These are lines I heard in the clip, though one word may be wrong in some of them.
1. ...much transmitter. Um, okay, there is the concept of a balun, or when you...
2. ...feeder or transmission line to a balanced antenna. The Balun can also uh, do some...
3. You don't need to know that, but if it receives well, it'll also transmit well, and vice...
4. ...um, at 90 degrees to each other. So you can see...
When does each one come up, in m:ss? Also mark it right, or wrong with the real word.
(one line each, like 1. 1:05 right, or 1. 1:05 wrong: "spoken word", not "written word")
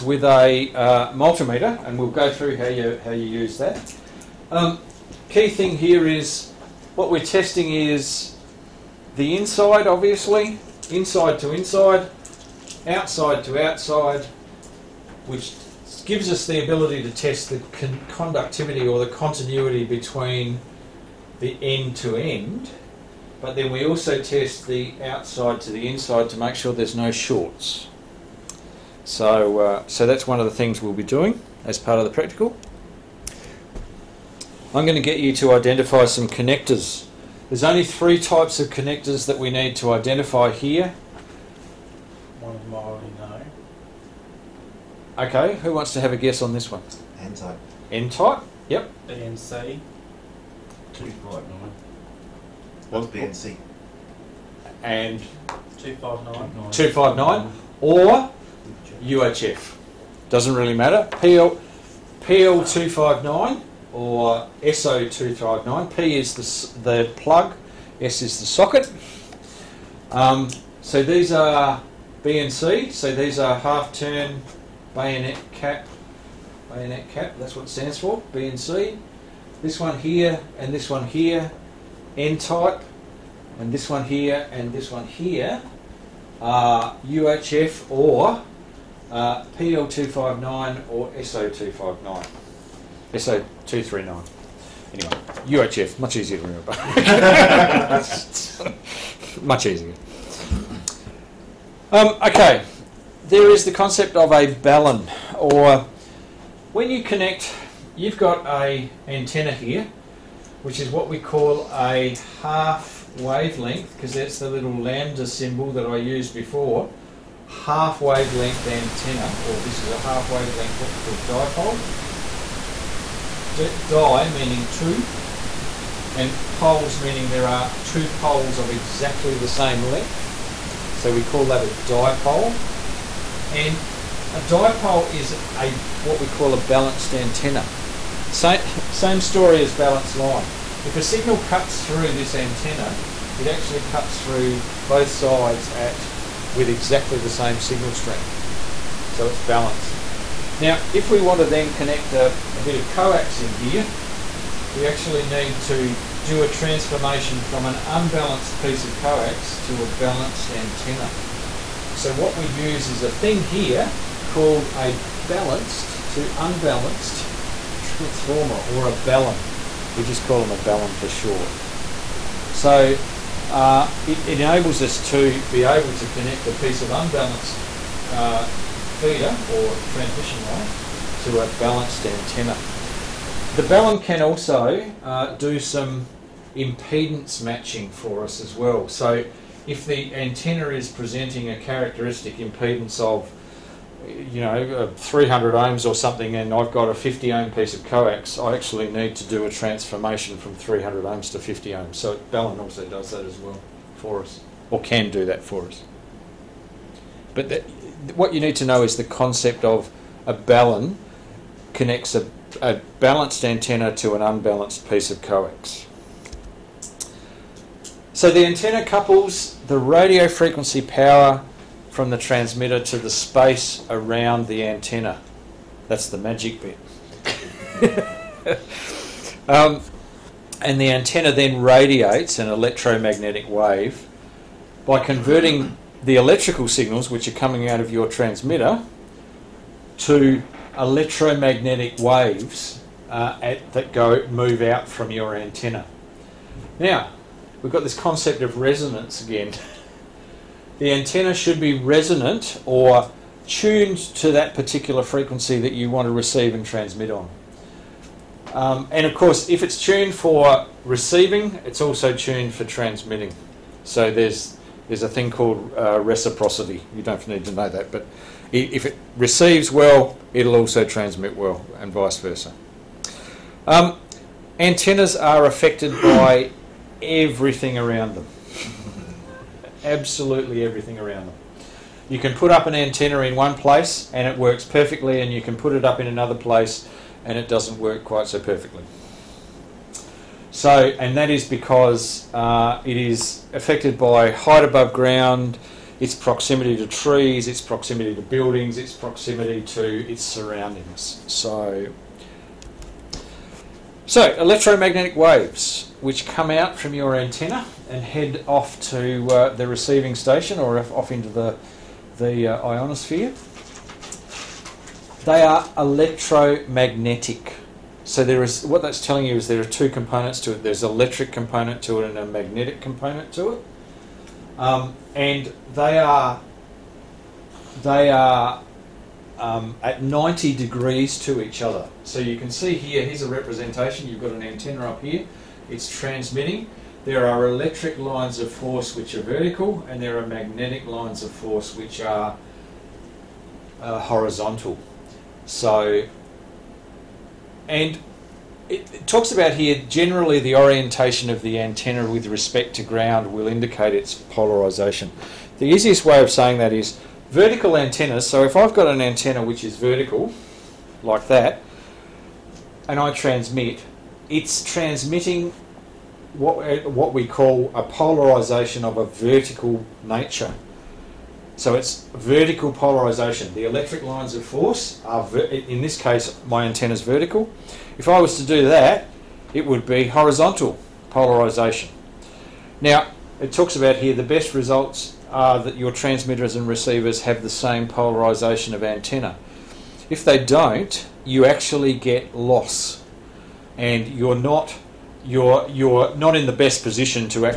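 1. 1:39 wrong: "easier", not "transmitter"
2. 2:58 right
3. 4:26 right
4. 5:29 right.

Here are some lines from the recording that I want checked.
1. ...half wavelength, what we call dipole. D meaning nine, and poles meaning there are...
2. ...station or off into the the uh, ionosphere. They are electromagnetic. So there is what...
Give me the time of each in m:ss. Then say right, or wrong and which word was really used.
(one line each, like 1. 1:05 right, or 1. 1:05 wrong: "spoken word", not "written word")
1. 1:59 wrong: "two", not "nine"
2. 5:10 right.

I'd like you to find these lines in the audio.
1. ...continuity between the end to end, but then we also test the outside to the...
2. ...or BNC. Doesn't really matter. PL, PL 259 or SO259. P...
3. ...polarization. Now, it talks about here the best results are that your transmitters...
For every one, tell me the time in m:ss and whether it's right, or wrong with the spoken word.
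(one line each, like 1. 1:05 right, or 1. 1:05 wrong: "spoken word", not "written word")
1. 0:19 right
2. 0:57 wrong: "UHF", not "BNC"
3. 6:21 right.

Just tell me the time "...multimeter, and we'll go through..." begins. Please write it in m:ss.
0:01.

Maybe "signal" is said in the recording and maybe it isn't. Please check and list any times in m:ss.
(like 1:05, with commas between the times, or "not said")
2:21, 2:27, 3:56.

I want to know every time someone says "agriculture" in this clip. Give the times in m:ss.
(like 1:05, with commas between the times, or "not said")
not said.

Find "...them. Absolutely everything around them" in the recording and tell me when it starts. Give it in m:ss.
4:38.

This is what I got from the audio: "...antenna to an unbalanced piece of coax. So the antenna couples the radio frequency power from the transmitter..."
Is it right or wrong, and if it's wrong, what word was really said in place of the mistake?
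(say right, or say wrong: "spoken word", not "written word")
right.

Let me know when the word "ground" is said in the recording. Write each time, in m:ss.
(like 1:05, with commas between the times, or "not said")
4:54, 5:52.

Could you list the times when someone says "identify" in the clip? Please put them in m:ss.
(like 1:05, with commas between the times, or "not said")
0:35, 0:39.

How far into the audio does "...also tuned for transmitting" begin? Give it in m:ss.
4:21.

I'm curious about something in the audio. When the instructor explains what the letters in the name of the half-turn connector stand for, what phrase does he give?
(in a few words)
bayonet cap.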